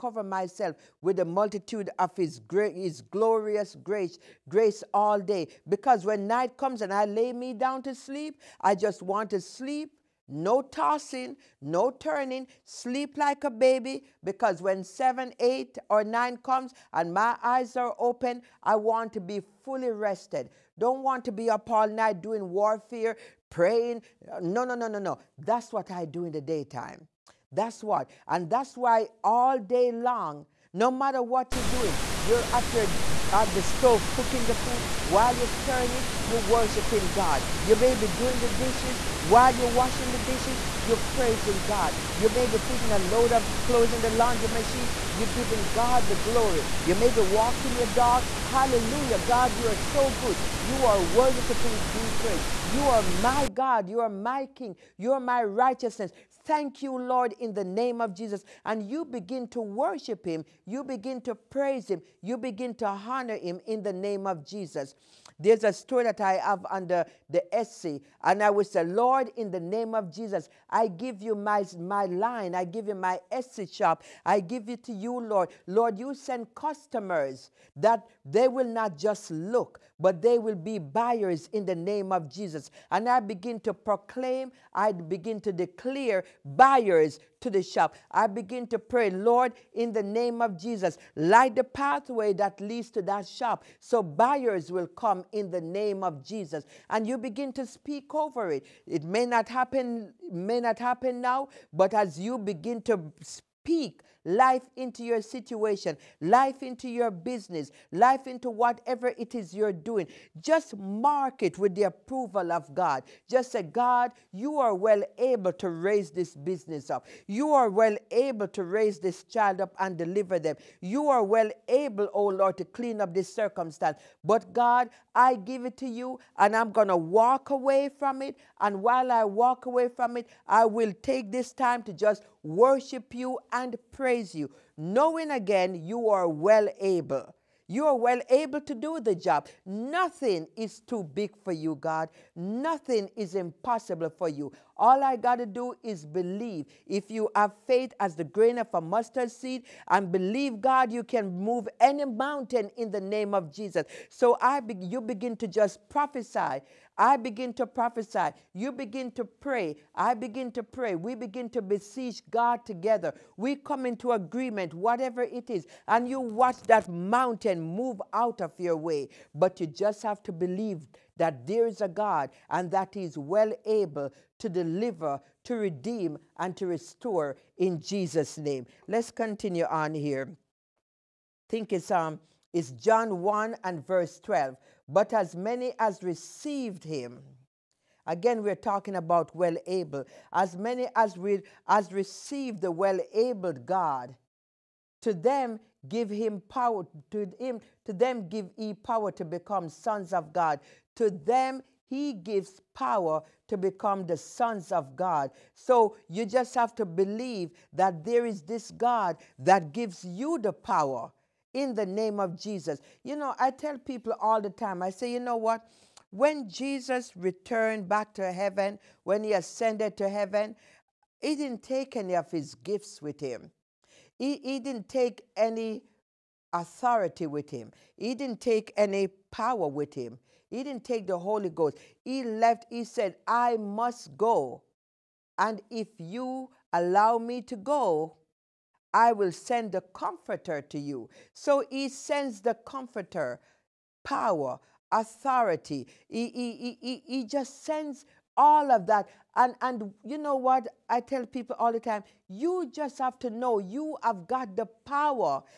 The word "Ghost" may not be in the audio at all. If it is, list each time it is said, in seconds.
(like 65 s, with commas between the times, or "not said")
231 s.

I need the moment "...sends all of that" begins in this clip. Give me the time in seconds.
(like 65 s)
247 s.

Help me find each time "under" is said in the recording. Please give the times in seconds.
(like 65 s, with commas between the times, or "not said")
66 s.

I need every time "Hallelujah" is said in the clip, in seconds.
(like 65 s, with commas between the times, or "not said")
48 s.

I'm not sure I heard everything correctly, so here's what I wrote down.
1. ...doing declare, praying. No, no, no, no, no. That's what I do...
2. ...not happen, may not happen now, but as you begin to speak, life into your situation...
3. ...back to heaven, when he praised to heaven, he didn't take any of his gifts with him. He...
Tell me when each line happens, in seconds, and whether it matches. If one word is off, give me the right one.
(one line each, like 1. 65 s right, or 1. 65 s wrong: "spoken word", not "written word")
1. 22 s wrong: "warfare", not "declare"
2. 99 s right
3. 217 s wrong: "ascended", not "praised".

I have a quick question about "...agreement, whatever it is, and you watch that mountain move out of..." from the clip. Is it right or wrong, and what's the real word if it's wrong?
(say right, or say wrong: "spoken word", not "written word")
right.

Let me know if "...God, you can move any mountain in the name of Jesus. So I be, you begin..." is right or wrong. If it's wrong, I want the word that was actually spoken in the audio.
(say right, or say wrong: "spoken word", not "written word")
right.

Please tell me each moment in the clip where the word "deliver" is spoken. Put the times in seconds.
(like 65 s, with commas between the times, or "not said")
119 s, 174 s.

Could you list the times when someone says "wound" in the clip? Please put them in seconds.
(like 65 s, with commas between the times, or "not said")
not said.